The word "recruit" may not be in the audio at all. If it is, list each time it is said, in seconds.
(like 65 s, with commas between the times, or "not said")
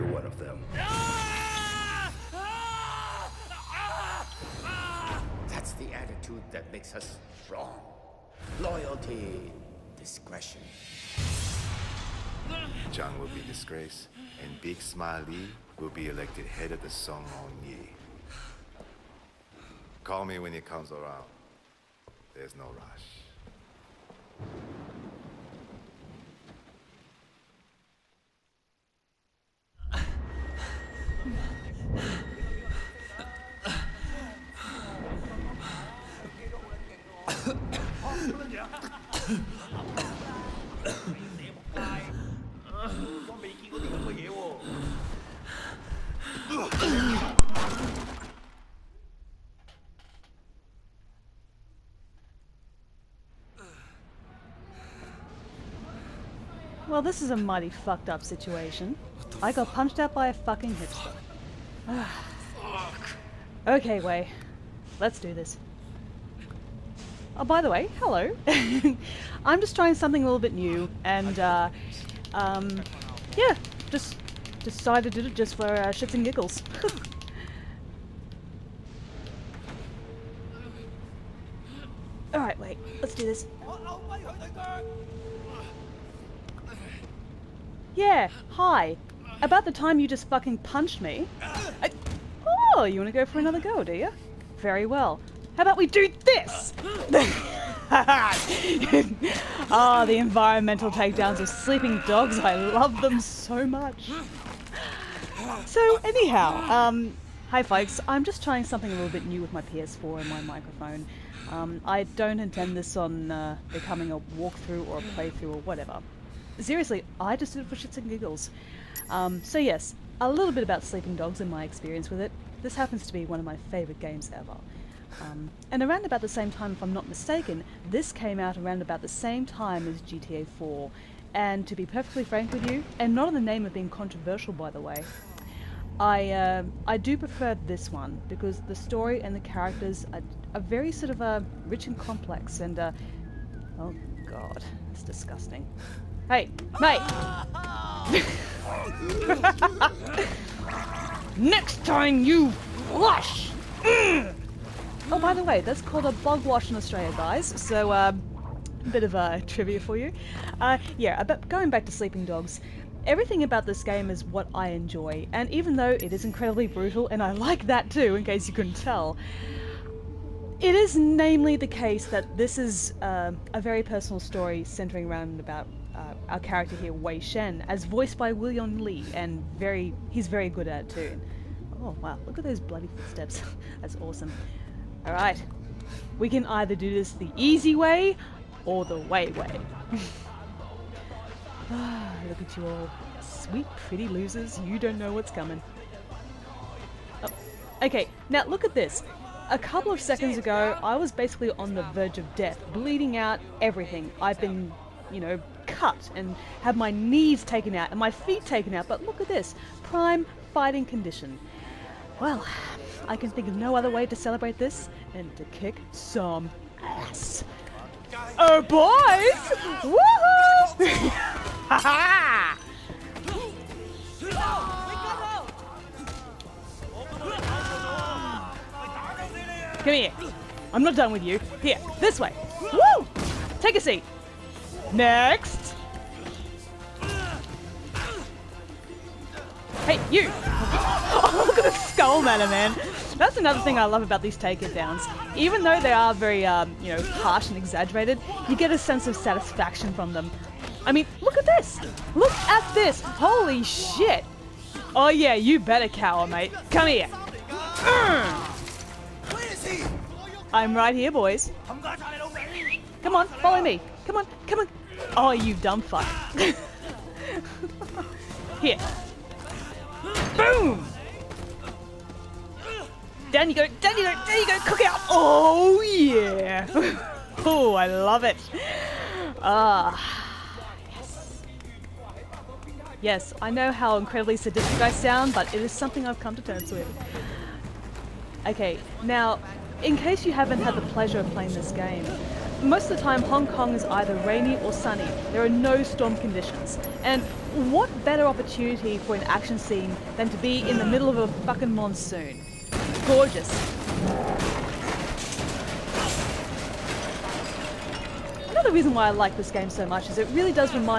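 not said.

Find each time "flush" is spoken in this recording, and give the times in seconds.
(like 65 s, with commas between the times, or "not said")
152 s.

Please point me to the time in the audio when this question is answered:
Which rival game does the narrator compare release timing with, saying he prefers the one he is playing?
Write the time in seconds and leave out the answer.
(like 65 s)
130 s.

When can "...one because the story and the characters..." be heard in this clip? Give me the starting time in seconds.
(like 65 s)
137 s.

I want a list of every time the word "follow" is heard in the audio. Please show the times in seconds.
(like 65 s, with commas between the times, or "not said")
263 s.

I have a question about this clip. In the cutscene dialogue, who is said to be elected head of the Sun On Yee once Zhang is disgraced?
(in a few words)
Big Smile Lee.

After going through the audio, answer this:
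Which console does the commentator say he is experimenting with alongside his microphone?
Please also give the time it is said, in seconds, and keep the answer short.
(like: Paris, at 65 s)
PS4, at 109 s.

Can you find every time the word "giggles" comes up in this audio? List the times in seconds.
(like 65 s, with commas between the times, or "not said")
76 s, 118 s.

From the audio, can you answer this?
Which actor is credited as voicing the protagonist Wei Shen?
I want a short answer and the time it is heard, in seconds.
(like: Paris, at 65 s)
William Lee, at 178 s.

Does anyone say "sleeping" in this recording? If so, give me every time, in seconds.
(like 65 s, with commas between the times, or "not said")
101 s, 120 s, 161 s.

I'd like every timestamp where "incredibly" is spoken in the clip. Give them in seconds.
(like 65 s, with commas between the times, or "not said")
166 s, 283 s.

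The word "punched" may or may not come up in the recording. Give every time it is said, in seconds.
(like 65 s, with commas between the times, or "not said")
59 s, 90 s.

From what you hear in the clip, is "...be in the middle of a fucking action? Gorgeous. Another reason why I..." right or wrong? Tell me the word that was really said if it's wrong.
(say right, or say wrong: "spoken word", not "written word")
wrong: "monsoon", not "action".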